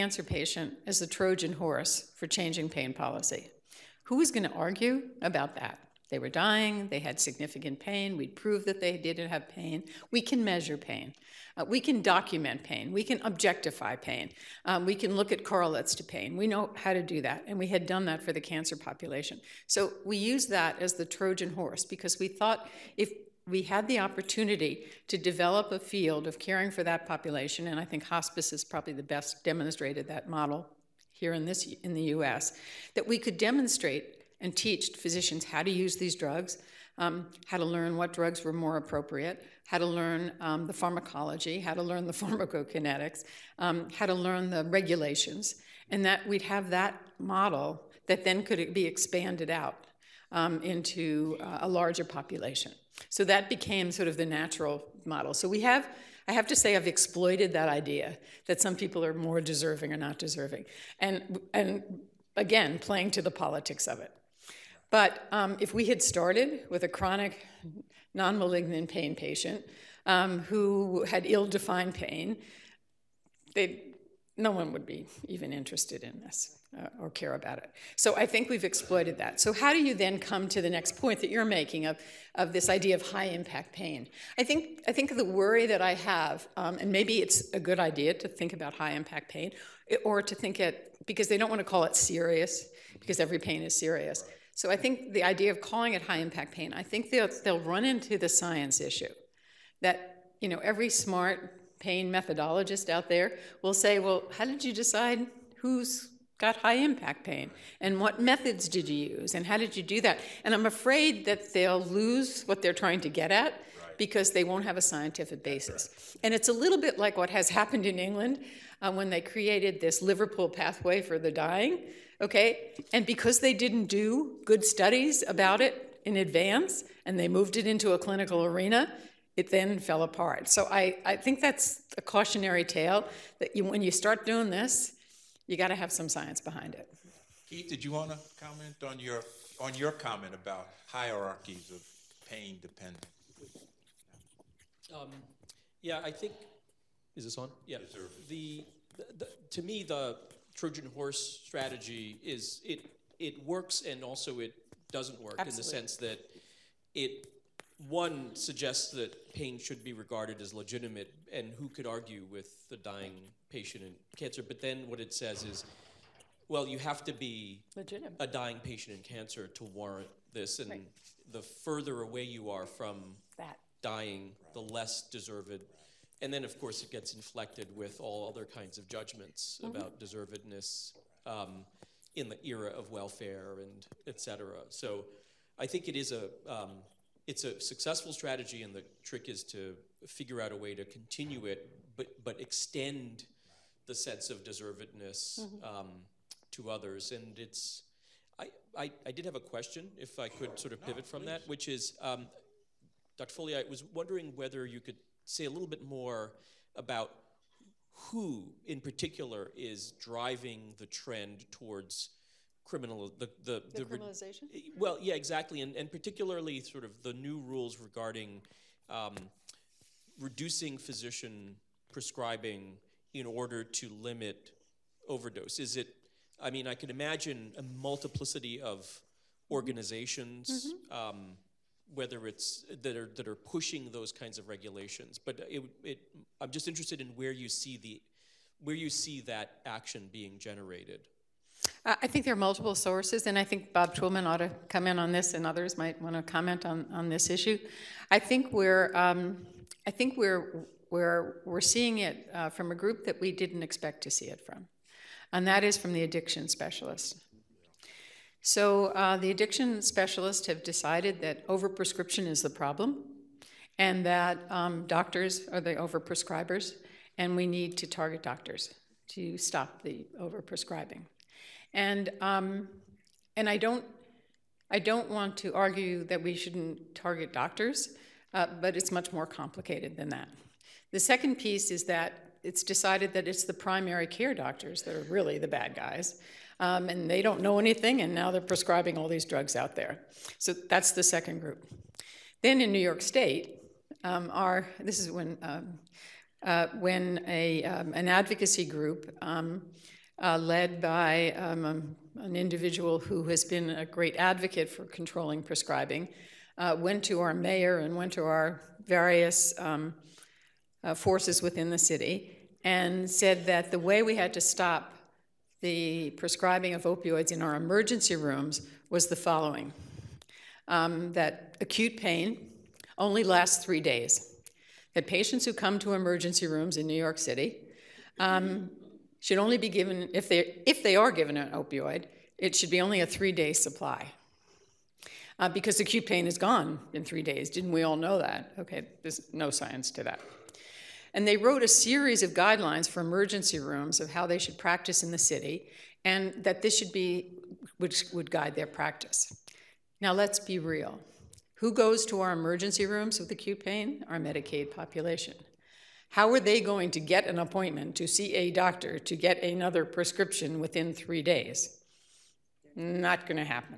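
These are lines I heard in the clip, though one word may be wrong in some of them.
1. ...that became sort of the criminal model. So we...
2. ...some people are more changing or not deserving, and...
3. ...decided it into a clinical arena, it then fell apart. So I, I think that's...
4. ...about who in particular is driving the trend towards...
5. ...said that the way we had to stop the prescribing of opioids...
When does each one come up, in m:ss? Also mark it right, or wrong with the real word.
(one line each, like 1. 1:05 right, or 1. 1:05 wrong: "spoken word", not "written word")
1. 0:53 wrong: "natural", not "criminal"
2. 0:58 wrong: "deserving", not "changing"
3. 2:07 wrong: "moved", not "decided"
4. 3:26 right
5. 5:13 right.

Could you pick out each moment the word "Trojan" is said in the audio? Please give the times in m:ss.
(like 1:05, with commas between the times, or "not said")
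0:01, 0:21, 2:30.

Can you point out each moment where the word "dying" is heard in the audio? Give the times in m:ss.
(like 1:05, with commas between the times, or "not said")
0:06, 2:01, 2:42, 2:48, 2:53.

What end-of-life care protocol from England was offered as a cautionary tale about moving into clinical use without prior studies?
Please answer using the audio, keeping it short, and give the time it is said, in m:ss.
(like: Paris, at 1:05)
Liverpool pathway, at 2:00.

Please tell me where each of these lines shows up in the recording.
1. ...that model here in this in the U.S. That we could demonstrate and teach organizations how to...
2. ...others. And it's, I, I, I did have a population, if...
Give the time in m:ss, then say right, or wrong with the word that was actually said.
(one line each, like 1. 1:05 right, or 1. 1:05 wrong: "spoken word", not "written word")
1. 0:30 wrong: "physicians", not "organizations"
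2. 3:16 wrong: "question", not "population".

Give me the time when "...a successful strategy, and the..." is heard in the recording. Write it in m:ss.
3:07.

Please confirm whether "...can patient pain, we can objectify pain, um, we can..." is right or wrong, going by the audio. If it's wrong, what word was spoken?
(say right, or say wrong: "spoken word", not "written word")
wrong: "document", not "patient".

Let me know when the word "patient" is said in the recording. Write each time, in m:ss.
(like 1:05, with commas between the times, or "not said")
0:00, 1:09, 2:43, 2:48, 5:25.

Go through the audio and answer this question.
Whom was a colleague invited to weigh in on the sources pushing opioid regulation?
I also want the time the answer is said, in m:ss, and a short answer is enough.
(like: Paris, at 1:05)
Bob Twillman, at 4:03.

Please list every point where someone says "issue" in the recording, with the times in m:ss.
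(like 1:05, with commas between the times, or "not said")
1:38, 4:07.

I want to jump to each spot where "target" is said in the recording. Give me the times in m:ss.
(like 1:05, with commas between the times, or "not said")
4:27, 4:36.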